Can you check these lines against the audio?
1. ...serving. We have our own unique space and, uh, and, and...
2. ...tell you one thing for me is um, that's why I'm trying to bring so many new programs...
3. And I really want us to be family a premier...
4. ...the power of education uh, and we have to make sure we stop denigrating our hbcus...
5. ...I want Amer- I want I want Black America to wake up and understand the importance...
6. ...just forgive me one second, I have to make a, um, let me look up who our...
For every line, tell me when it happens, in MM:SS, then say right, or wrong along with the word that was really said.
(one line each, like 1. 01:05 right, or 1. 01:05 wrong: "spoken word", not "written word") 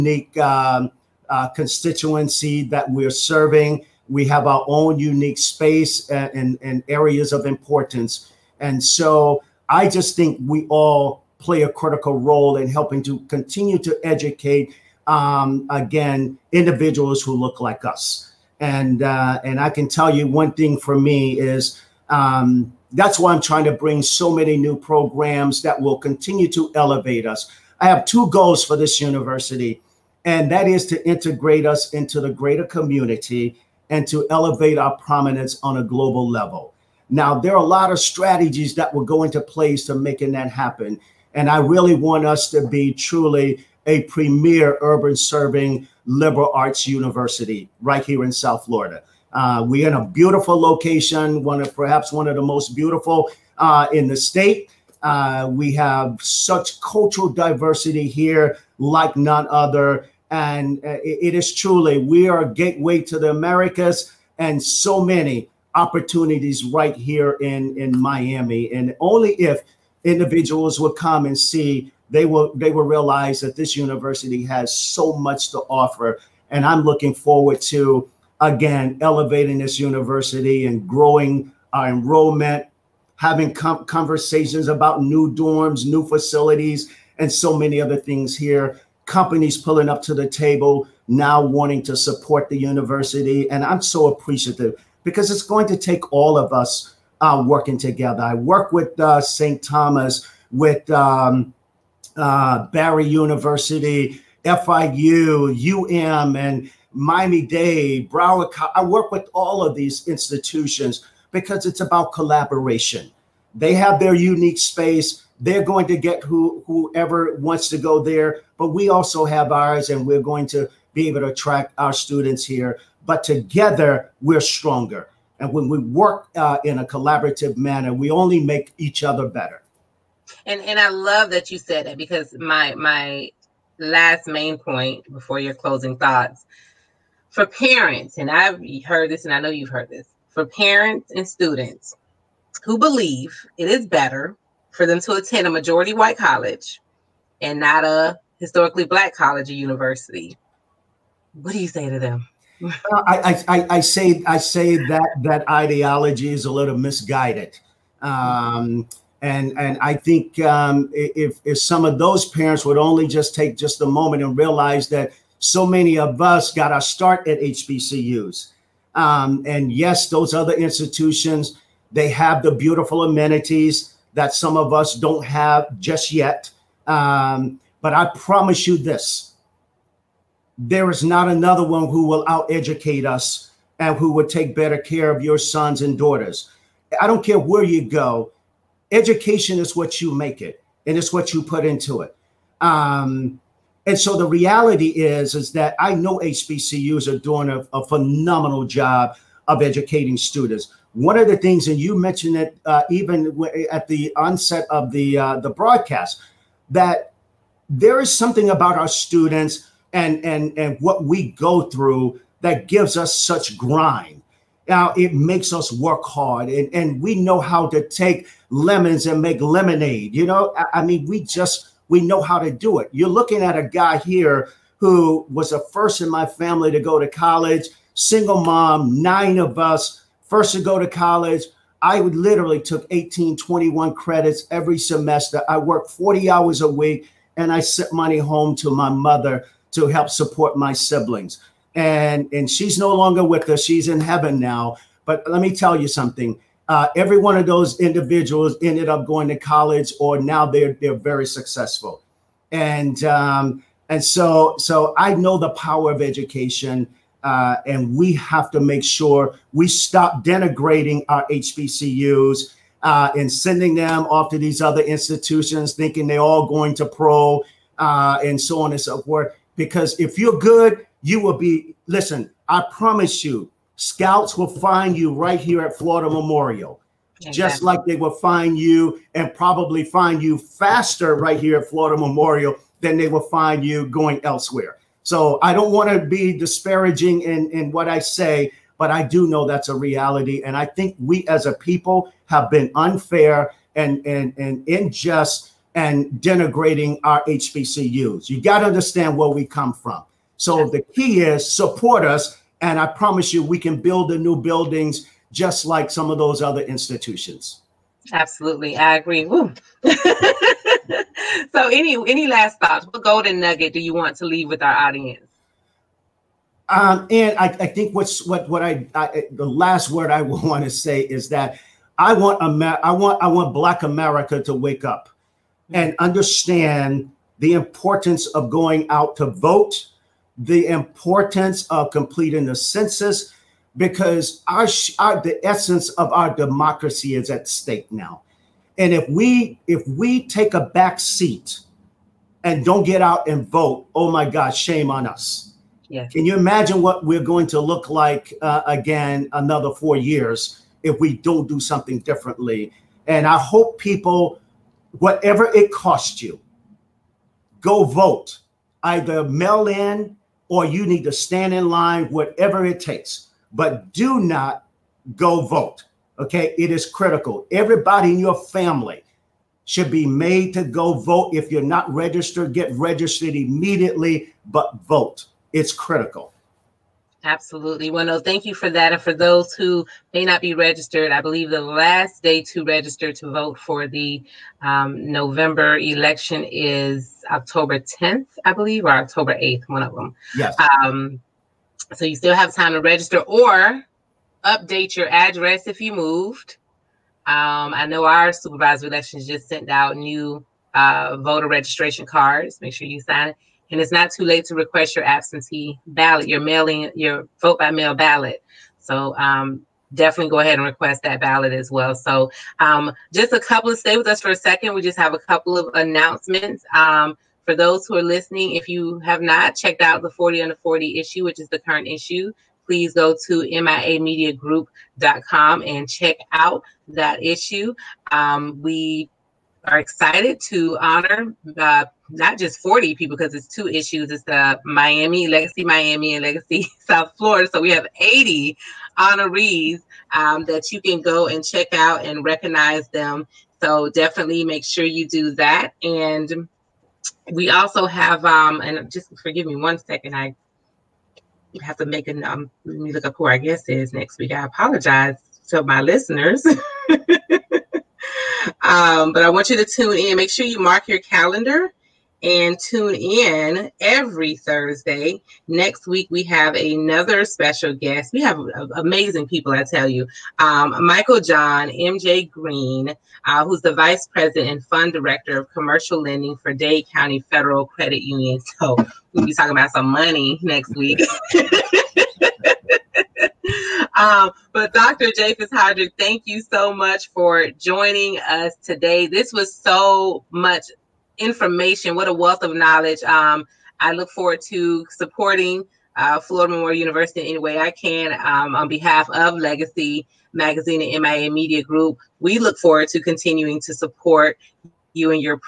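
1. 00:03 right
2. 00:19 right
3. 00:41 wrong: "truly", not "family"
4. 04:15 right
5. 05:21 right
6. 07:28 right.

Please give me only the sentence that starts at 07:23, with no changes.
So definitely make sure you do that.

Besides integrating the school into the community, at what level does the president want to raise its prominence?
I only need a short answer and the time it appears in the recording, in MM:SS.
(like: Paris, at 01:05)
global level, at 00:35.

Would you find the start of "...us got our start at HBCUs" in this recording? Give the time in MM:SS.
02:46.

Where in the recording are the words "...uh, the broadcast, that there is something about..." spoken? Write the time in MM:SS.
03:25.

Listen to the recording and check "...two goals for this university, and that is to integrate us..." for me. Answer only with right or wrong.
right.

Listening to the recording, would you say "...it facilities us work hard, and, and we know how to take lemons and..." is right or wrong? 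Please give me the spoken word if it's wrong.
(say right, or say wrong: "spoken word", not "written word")
wrong: "makes", not "facilities".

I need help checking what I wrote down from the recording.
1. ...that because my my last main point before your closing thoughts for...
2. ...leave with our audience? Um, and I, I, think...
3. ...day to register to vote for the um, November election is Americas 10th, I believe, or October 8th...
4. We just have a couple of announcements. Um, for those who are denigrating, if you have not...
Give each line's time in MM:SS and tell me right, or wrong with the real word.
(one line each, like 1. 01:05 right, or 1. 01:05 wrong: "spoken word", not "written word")
1. 02:11 right
2. 05:14 right
3. 06:22 wrong: "October", not "Americas"
4. 06:54 wrong: "listening", not "denigrating".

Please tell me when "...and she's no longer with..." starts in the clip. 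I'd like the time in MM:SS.
04:02.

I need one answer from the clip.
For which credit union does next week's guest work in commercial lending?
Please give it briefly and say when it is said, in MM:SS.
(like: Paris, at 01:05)
Dade County Federal Credit Union, at 07:56.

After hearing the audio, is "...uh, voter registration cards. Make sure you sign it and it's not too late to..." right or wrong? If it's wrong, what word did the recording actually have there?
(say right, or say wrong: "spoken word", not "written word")
right.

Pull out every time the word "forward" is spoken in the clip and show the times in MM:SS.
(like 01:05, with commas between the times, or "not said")
01:17, 08:14, 08:22.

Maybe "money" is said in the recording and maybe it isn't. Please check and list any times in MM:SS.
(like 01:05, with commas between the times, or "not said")
03:57, 07:59.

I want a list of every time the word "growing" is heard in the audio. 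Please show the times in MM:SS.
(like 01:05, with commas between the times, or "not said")
01:20.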